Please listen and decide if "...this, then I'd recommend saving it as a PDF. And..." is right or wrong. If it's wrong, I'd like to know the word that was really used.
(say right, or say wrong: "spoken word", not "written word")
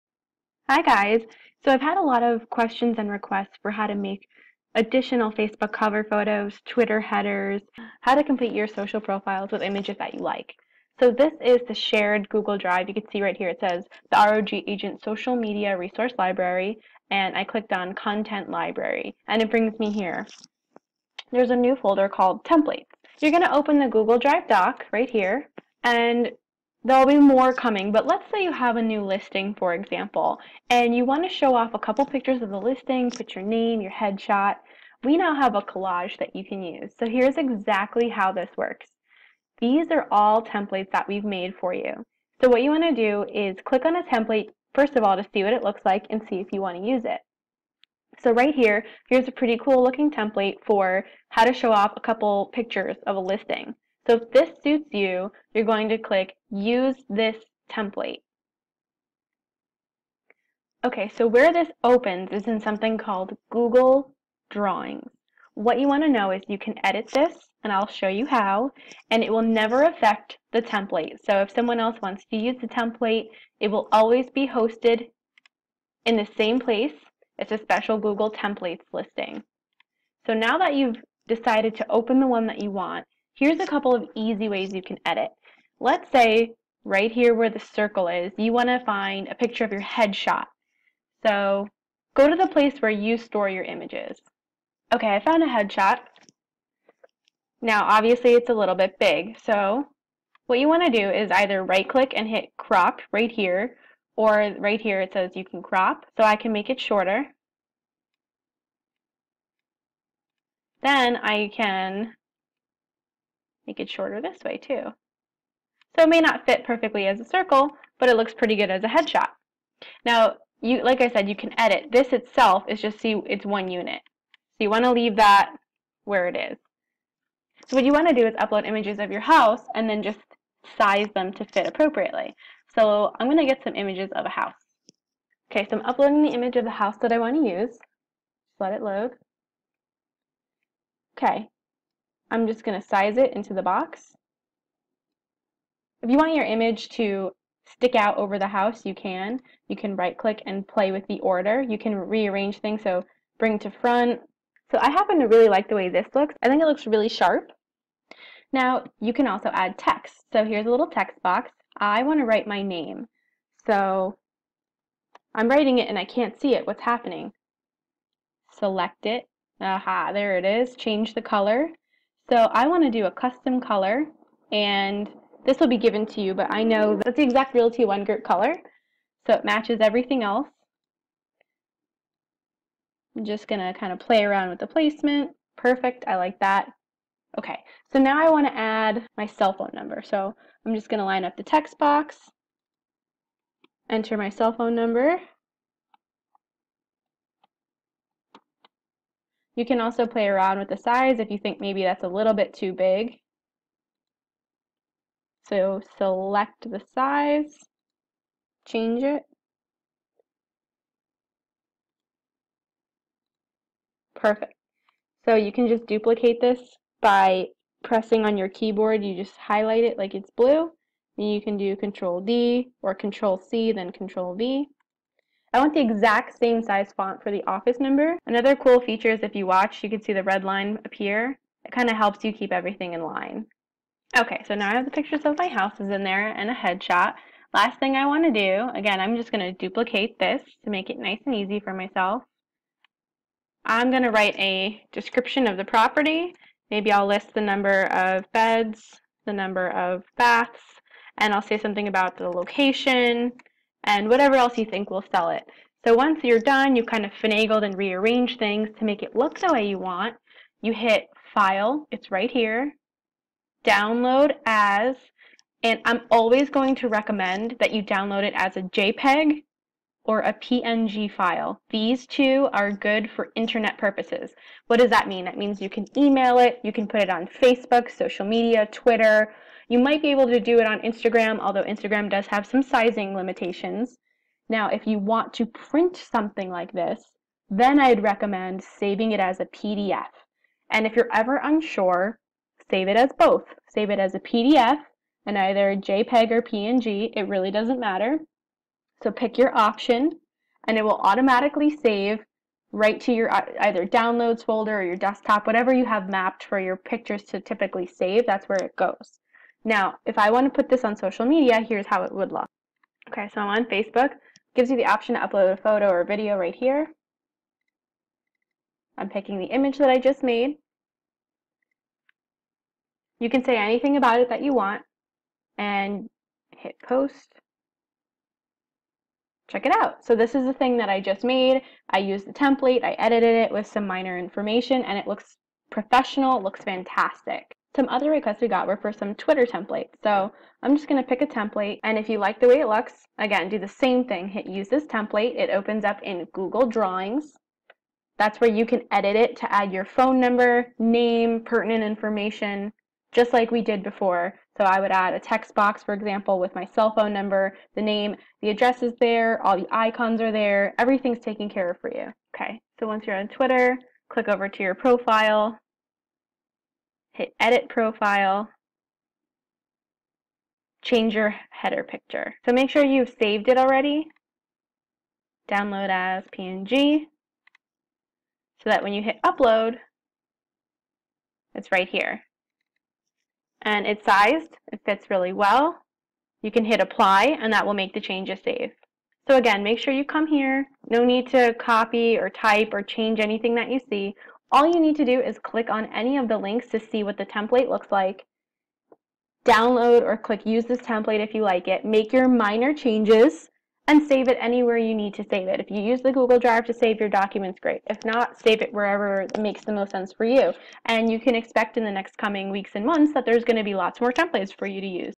right.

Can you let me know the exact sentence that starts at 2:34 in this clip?
So I happen to really like the way this looks.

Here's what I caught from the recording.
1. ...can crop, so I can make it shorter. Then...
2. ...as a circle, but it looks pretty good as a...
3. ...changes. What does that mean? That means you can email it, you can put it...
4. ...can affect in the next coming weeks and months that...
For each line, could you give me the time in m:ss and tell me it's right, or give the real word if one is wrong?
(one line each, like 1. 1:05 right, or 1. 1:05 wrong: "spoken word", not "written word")
1. 1:45 right
2. 1:57 right
3. 4:33 wrong: "purposes", not "changes"
4. 6:51 wrong: "expect", not "affect".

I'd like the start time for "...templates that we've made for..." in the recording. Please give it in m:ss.
0:40.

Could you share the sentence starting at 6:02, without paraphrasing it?
Okay, so once you're on Twitter, click over to your profile, hit edit profile, change your header picture.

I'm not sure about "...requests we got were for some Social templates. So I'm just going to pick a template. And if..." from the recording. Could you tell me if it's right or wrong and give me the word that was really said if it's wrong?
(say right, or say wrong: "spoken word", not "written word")
wrong: "Twitter", not "Social".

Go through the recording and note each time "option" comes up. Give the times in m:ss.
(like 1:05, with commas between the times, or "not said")
4:59, 5:14.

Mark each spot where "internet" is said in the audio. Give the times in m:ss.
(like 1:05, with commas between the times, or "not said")
4:33.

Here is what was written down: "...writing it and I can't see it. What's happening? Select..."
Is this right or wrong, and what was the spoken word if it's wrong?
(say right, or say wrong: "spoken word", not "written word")
right.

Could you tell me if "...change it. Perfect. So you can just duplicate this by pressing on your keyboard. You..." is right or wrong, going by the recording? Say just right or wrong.
right.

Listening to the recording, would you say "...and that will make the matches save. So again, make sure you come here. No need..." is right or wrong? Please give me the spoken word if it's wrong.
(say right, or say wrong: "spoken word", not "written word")
wrong: "changes", not "matches".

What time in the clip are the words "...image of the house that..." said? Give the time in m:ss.
2:16.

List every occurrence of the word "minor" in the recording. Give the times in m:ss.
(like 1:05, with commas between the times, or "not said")
5:33, 6:42.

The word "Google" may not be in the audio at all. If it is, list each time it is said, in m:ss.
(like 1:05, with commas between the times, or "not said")
0:12, 0:23, 1:03, 1:17, 5:46, 6:46.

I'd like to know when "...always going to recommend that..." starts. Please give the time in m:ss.
4:26.